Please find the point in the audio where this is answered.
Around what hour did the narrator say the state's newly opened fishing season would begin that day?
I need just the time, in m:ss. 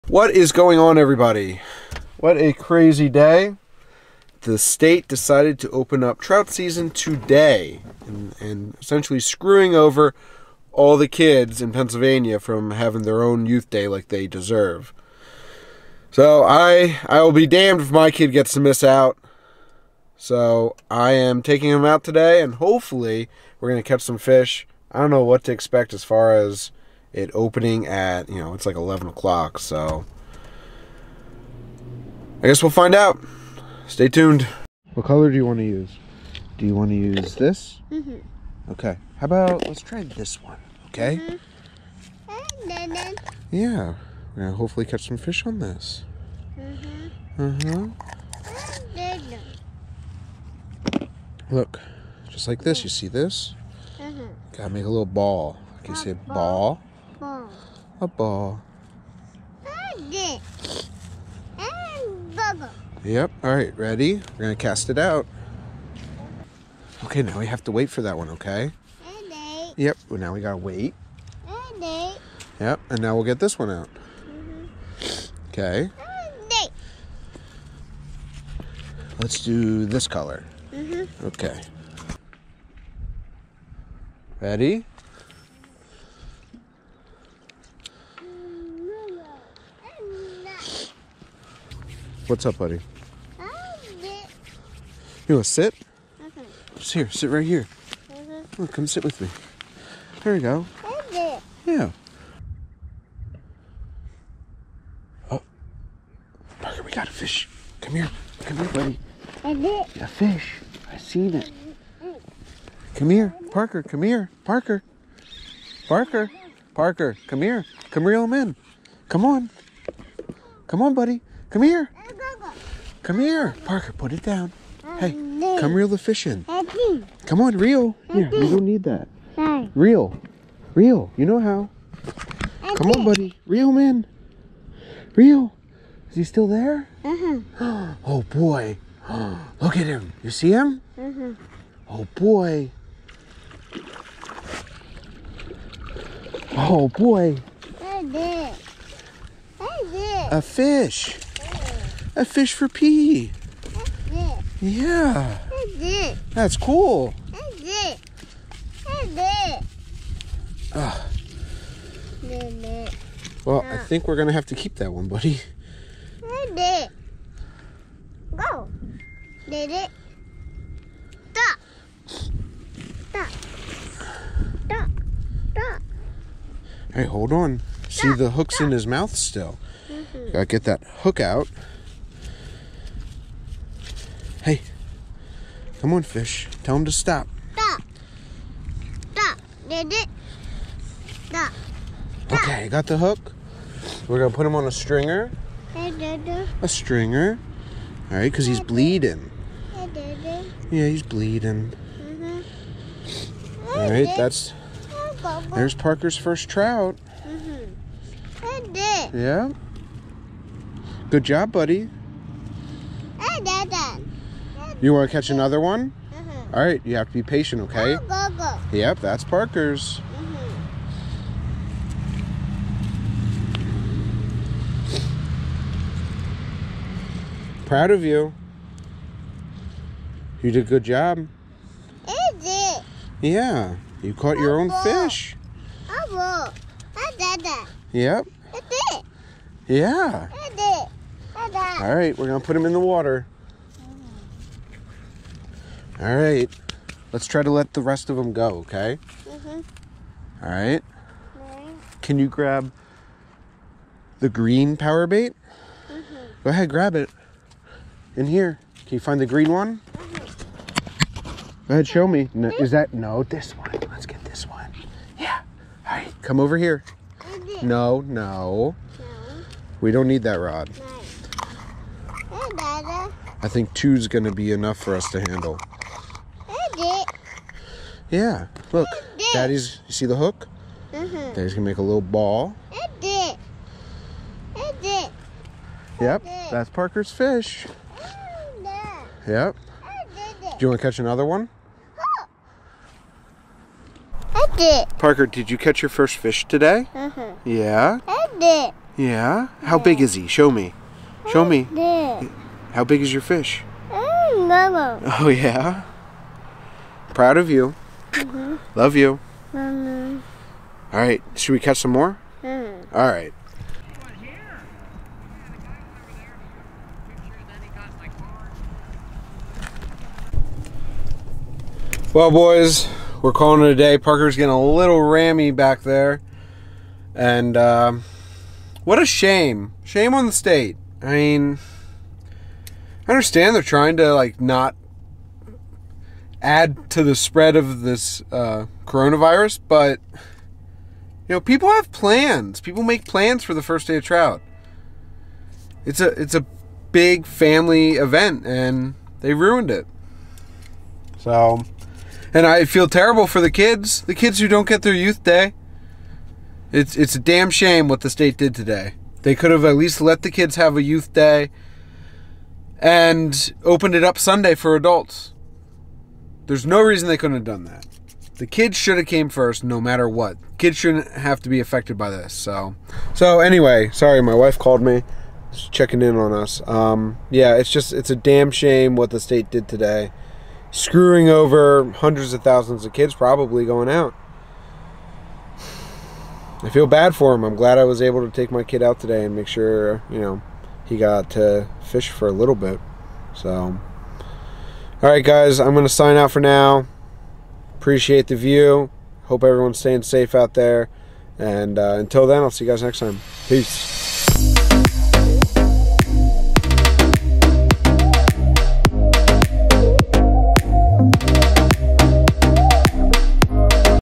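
0:28.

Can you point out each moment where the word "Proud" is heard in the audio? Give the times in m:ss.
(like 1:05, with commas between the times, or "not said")
3:47, 5:07.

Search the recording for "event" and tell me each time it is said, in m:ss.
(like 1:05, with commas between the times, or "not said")
5:47.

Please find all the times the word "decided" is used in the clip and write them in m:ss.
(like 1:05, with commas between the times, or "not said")
0:05.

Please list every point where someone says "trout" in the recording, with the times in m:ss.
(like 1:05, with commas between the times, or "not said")
0:06, 3:26, 5:44.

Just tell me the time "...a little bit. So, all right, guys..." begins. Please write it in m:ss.
6:32.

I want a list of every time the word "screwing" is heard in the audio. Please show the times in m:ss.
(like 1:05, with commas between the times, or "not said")
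0:09, 6:20.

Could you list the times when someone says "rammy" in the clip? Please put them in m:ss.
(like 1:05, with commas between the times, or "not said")
5:25.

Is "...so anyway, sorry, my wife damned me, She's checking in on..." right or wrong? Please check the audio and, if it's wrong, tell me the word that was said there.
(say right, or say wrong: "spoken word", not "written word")
wrong: "called", not "damned".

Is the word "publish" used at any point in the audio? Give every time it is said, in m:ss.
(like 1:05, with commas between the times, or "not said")
not said.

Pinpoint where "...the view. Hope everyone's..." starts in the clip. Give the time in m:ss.
6:38.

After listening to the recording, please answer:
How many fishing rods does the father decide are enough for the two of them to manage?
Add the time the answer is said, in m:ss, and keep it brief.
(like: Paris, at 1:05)
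2, at 4:33.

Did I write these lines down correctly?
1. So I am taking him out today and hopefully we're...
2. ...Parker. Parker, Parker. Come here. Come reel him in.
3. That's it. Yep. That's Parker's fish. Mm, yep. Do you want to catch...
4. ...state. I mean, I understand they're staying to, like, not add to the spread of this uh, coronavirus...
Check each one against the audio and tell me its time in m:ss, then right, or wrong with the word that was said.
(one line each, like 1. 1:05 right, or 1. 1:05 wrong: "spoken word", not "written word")
1. 0:20 right
2. 1:54 right
3. 4:44 right
4. 5:30 wrong: "trying", not "staying".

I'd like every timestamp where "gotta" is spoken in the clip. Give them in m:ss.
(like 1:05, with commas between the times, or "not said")
0:54, 1:10, 3:00.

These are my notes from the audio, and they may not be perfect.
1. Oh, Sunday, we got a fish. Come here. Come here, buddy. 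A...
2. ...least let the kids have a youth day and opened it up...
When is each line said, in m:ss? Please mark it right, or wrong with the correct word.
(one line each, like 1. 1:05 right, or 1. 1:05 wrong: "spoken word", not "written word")
1. 1:45 wrong: "Parker", not "Sunday"
2. 5:59 right.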